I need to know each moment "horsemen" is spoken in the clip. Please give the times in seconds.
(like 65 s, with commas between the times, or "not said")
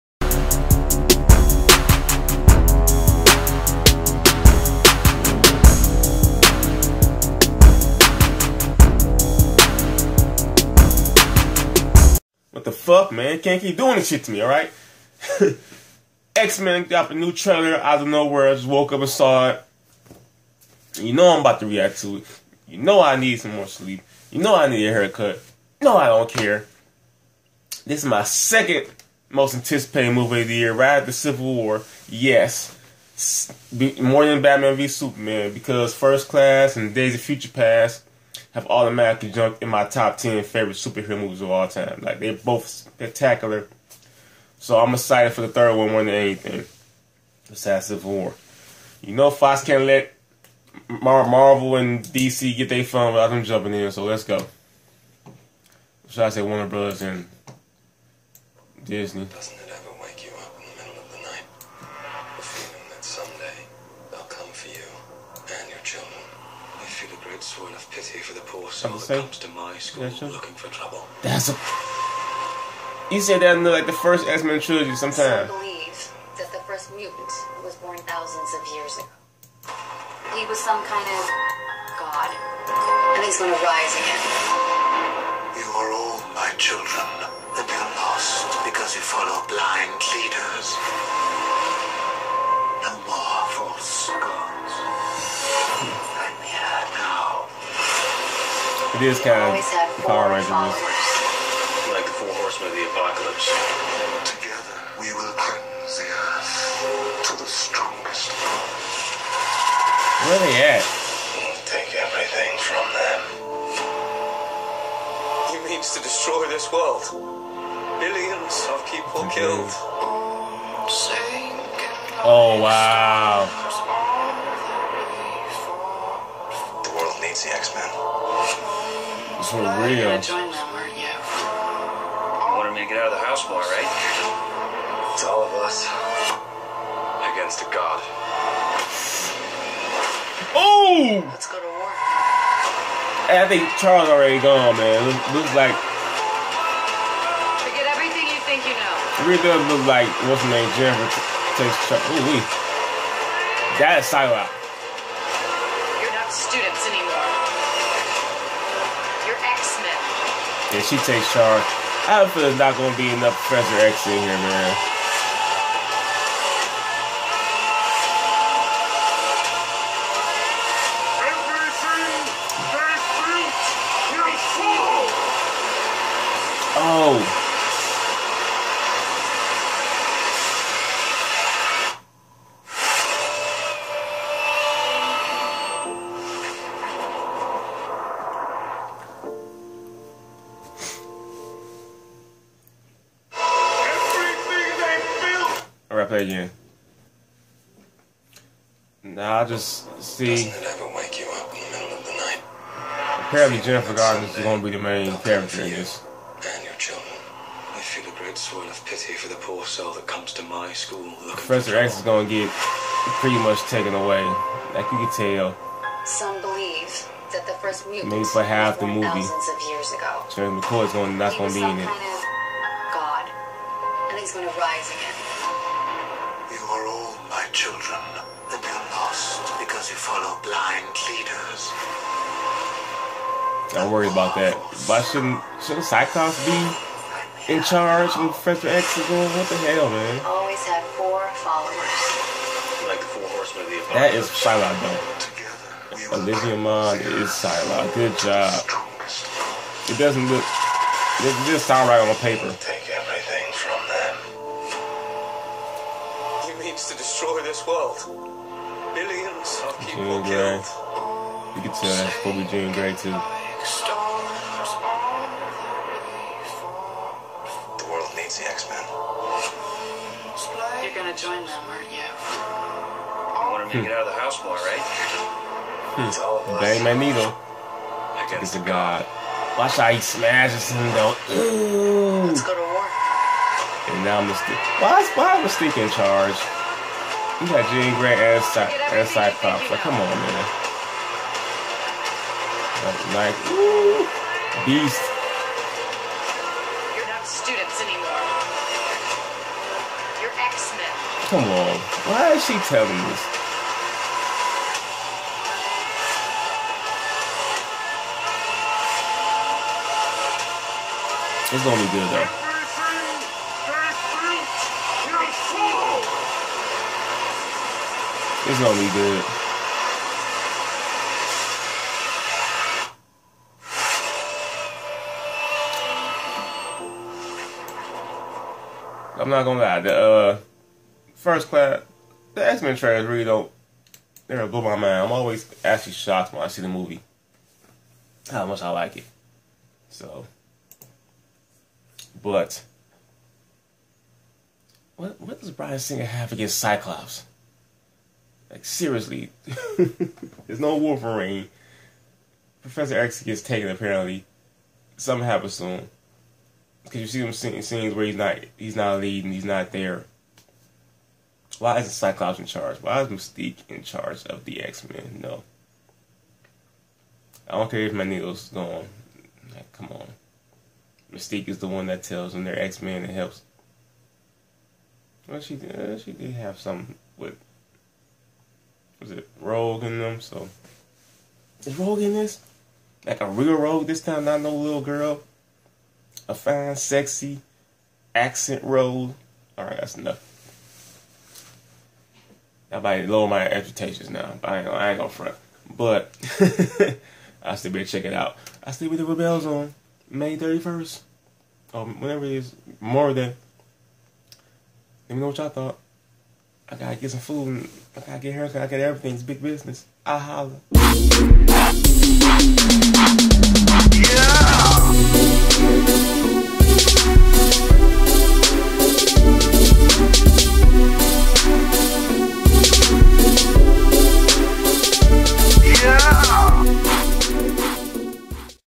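102 s, 243 s.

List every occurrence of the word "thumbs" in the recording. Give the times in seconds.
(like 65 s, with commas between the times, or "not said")
not said.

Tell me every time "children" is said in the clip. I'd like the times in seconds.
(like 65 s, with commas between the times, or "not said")
86 s, 206 s, 227 s.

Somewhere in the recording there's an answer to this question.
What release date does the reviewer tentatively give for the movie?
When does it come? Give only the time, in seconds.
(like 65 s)
400 s.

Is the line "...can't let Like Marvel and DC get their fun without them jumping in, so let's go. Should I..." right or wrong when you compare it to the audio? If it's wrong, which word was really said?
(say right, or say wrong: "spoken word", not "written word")
wrong: "Mar", not "Like".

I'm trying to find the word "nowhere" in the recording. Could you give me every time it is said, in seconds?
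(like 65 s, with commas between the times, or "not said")
18 s.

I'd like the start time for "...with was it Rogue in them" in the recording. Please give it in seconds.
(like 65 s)
377 s.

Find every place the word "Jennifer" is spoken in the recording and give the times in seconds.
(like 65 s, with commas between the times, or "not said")
150 s, 203 s.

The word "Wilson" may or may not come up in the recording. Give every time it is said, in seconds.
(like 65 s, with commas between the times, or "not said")
not said.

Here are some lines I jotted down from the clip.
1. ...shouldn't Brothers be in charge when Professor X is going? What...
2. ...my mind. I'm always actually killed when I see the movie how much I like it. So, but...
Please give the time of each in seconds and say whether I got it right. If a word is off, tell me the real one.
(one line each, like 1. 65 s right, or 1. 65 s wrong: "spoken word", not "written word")
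1. 235 s wrong: "Cyclops", not "Brothers"
2. 334 s wrong: "shocked", not "killed".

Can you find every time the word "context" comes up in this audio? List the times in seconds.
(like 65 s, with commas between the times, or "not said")
not said.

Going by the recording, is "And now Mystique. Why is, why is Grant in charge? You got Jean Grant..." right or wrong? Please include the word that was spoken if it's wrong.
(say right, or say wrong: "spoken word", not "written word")
wrong: "Mystique", not "Grant".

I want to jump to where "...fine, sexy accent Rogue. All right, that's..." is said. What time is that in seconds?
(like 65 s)
386 s.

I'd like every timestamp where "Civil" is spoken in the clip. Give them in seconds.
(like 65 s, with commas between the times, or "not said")
31 s, 48 s.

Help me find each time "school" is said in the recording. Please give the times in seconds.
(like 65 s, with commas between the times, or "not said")
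69 s, 210 s.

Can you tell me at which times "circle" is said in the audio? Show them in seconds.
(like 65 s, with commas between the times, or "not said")
not said.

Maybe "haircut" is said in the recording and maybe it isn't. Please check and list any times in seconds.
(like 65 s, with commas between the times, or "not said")
24 s, 408 s.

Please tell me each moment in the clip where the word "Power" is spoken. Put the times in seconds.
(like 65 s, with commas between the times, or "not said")
100 s.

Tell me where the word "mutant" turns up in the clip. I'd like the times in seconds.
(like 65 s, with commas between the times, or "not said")
76 s, 217 s.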